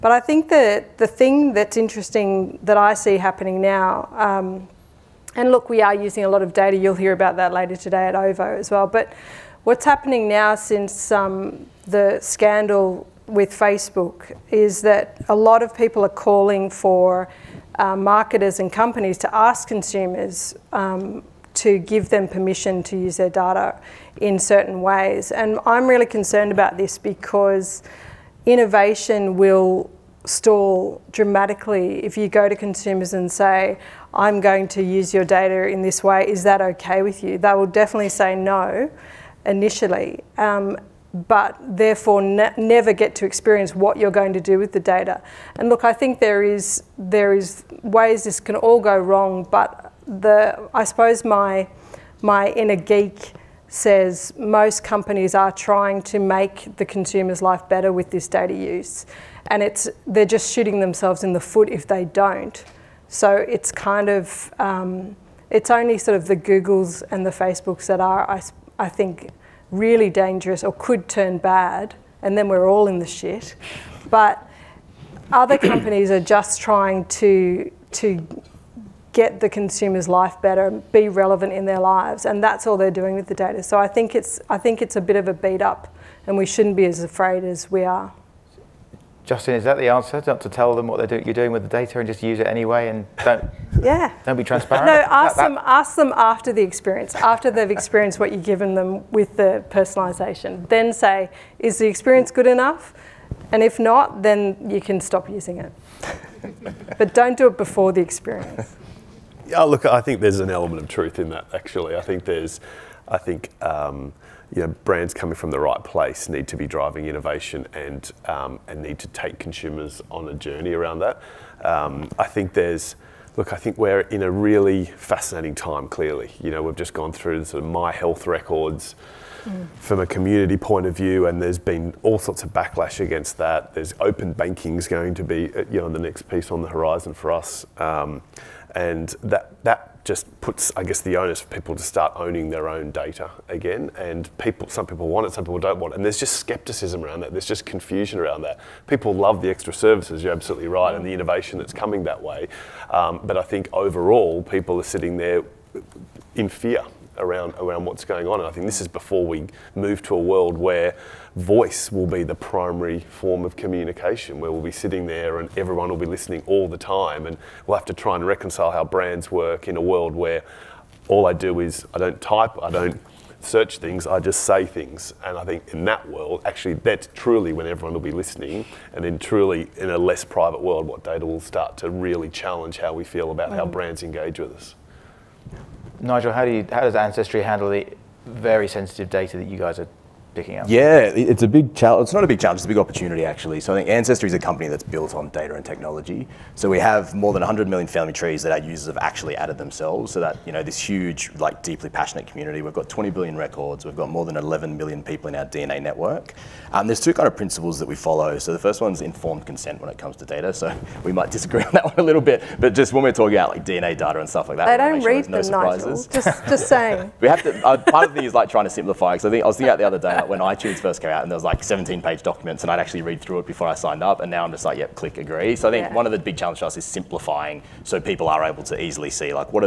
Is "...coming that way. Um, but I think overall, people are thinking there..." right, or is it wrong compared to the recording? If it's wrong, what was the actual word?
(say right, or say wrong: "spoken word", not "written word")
wrong: "sitting", not "thinking".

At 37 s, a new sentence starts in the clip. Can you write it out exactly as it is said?
They will definitely say no initially, um, but therefore ne never get to experience what you're going to do with the data.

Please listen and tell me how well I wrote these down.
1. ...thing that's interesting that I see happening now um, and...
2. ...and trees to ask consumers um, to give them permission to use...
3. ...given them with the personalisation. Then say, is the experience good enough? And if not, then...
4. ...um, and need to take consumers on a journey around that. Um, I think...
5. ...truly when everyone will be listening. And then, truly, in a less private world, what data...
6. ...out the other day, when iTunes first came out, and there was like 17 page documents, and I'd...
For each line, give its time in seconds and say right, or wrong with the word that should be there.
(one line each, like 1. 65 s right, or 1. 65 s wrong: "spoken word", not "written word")
1. 1 s right
2. 18 s wrong: "companies", not "trees"
3. 98 s right
4. 118 s right
5. 177 s right
6. 219 s right.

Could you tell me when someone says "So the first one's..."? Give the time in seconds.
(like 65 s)
208 s.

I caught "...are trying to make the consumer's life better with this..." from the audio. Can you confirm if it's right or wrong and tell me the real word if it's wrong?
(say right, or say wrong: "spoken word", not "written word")
right.